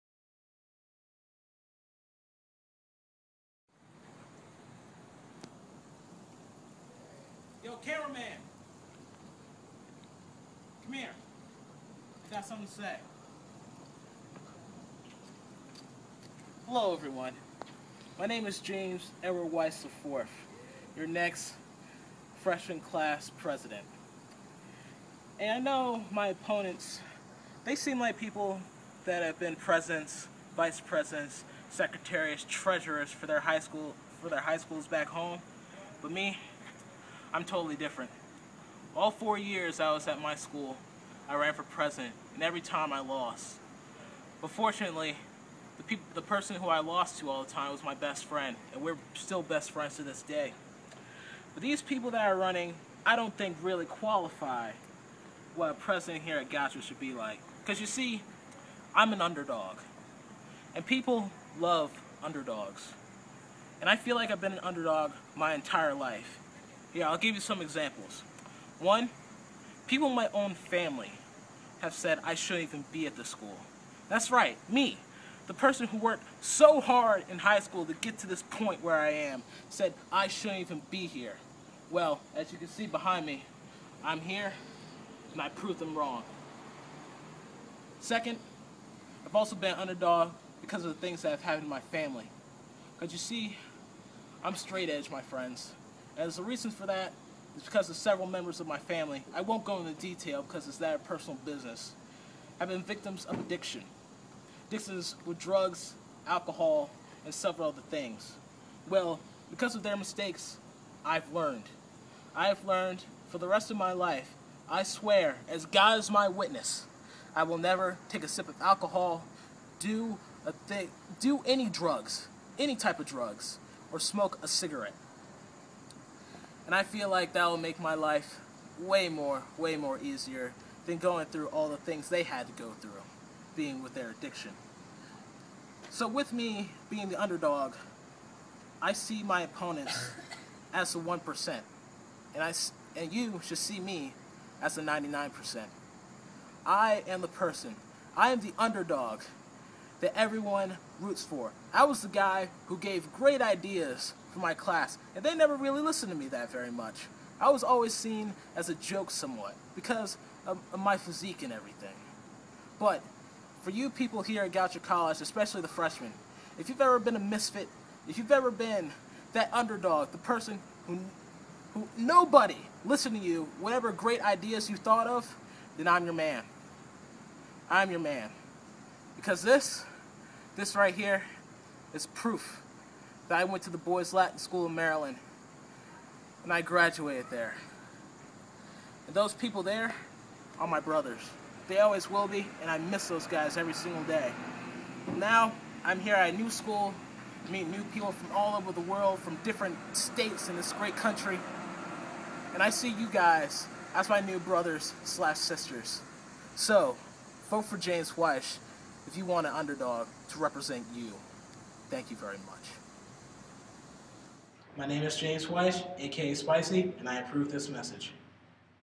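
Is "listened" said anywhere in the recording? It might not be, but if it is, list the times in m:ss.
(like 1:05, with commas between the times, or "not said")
2:35, 2:52.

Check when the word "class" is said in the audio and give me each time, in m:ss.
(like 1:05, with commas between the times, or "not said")
0:22, 2:34.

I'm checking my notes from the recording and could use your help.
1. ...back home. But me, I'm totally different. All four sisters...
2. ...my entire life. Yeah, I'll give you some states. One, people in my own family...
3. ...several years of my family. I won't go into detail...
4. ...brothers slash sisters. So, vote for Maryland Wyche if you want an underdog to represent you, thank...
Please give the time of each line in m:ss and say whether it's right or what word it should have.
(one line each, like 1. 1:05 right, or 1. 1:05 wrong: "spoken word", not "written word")
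1. 0:34 wrong: "years", not "sisters"
2. 1:05 wrong: "examples", not "states"
3. 1:37 wrong: "members", not "years"
4. 3:24 wrong: "James", not "Maryland".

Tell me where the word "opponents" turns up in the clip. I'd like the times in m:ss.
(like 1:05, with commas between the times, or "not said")
0:26, 2:19.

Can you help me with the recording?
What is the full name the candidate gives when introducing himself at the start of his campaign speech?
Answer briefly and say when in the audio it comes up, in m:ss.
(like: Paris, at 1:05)
James Edward Wyche IV, at 0:18.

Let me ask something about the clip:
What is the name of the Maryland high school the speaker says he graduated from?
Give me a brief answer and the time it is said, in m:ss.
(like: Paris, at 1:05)
Boys Latin School, at 3:03.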